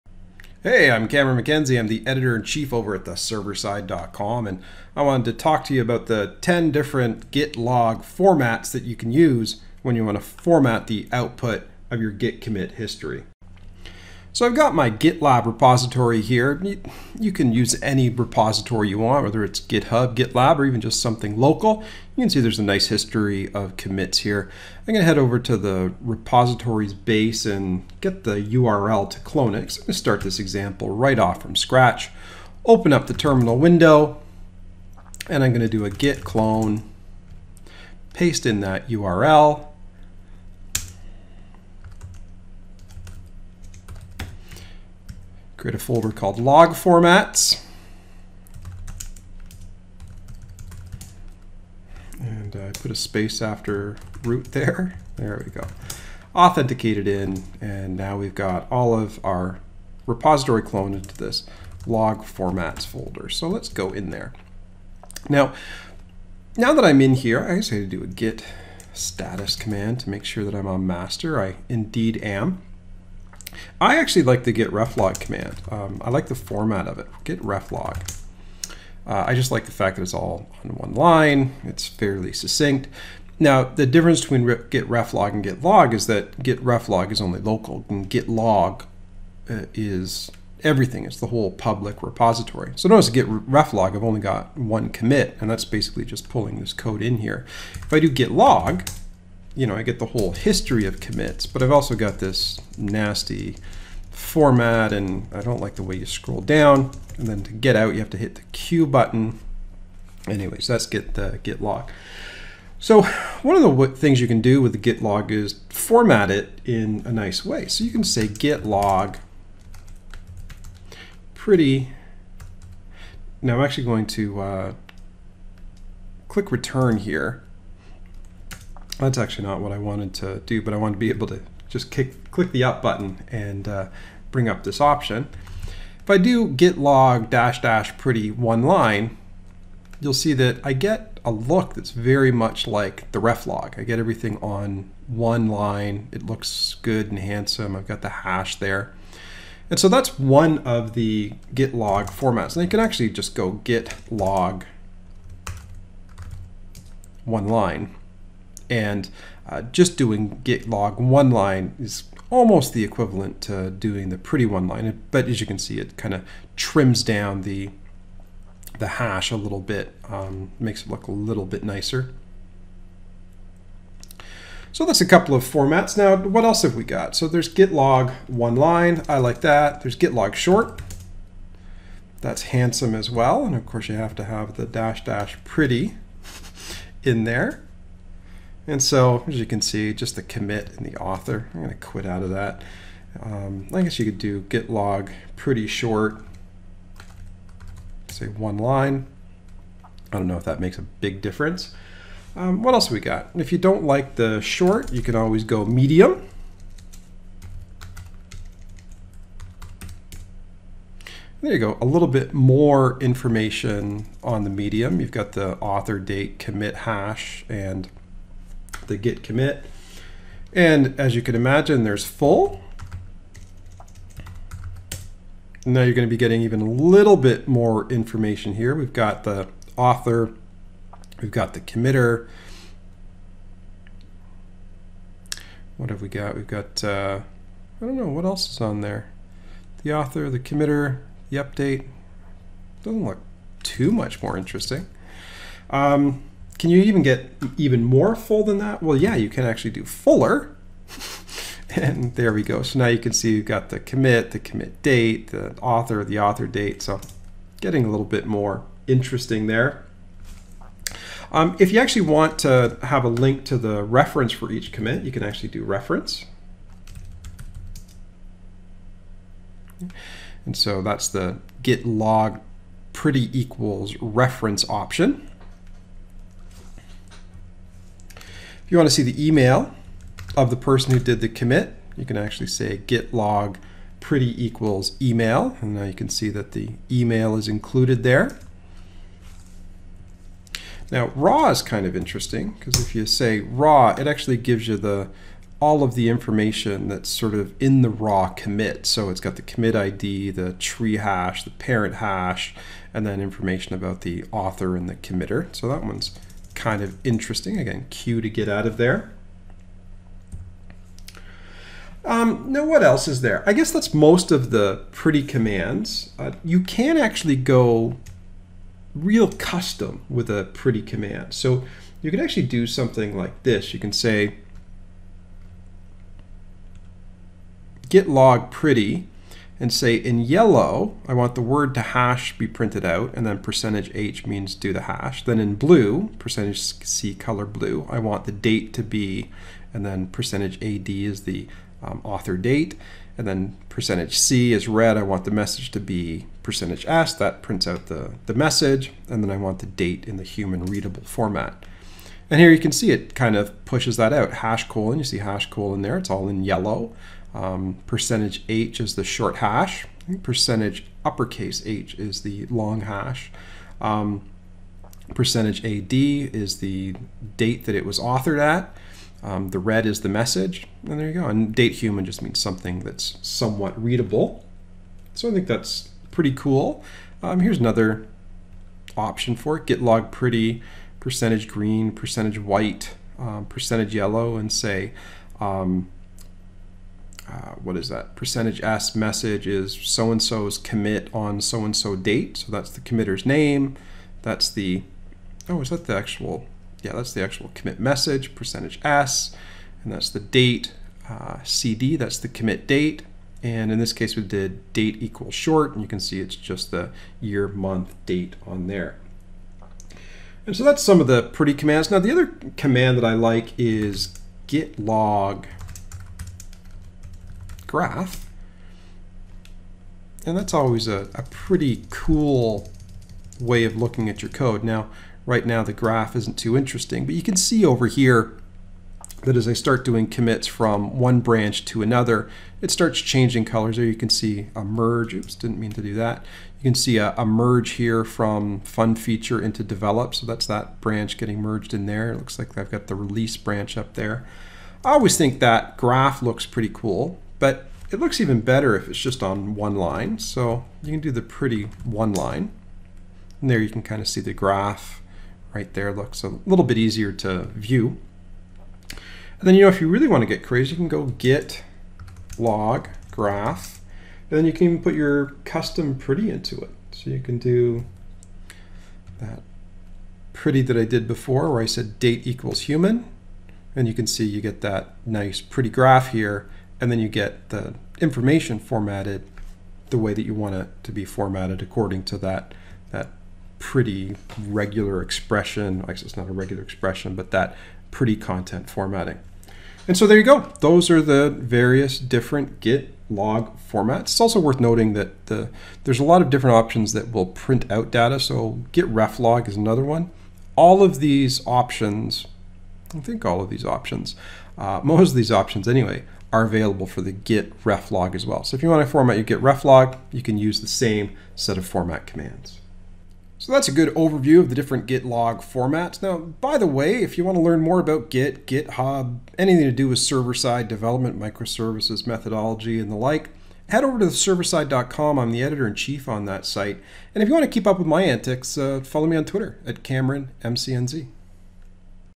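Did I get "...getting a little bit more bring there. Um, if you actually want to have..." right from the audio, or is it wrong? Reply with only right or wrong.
wrong.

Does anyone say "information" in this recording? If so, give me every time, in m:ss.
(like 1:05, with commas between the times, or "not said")
3:33, 3:47, 4:56, 5:03, 7:58.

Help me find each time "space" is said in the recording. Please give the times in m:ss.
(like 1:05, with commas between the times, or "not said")
0:52.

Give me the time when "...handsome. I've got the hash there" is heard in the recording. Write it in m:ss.
2:27.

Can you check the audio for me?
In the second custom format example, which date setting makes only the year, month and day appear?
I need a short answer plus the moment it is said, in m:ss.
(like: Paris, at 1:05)
date equals short, at 6:44.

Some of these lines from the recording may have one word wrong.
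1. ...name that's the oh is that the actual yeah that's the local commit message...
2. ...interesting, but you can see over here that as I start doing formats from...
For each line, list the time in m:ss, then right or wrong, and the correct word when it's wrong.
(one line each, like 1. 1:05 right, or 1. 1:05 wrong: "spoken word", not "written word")
1. 6:33 wrong: "actual", not "local"
2. 7:06 wrong: "commits", not "formats".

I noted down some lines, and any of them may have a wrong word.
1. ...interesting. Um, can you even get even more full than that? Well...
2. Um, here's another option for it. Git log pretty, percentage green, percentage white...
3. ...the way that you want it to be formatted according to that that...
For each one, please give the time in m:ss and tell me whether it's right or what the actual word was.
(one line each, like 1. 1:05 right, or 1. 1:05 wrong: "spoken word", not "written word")
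1. 4:04 right
2. 6:17 right
3. 7:59 right.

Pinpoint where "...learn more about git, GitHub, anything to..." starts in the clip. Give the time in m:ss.
8:37.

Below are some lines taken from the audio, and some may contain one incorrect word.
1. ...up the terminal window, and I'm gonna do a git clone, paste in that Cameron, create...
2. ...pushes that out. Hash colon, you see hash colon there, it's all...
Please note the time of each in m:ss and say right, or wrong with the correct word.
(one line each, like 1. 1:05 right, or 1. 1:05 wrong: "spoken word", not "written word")
1. 0:32 wrong: "URL", not "Cameron"
2. 5:53 right.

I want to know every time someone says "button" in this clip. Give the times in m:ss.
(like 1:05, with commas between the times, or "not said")
1:48, 2:12.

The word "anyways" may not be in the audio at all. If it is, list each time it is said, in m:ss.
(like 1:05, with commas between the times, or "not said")
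1:50, 8:25.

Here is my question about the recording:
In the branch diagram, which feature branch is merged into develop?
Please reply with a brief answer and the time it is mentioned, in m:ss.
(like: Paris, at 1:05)
fun feature, at 7:18.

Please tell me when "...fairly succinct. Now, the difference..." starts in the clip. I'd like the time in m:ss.
1:21.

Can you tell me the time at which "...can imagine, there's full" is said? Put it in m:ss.
3:41.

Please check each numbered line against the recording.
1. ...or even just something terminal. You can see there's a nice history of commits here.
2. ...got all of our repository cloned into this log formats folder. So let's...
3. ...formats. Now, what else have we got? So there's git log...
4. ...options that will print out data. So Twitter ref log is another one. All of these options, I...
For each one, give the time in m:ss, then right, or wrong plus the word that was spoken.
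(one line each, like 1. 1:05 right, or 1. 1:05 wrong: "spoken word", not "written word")
1. 0:20 wrong: "local", not "terminal"
2. 0:58 right
3. 2:55 right
4. 8:16 wrong: "Git", not "Twitter".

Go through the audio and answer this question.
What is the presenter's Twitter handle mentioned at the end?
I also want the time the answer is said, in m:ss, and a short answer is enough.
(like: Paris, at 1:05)
CameronMCNZ, at 8:49.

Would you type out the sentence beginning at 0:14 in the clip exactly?
So I've got my GitLab repository here.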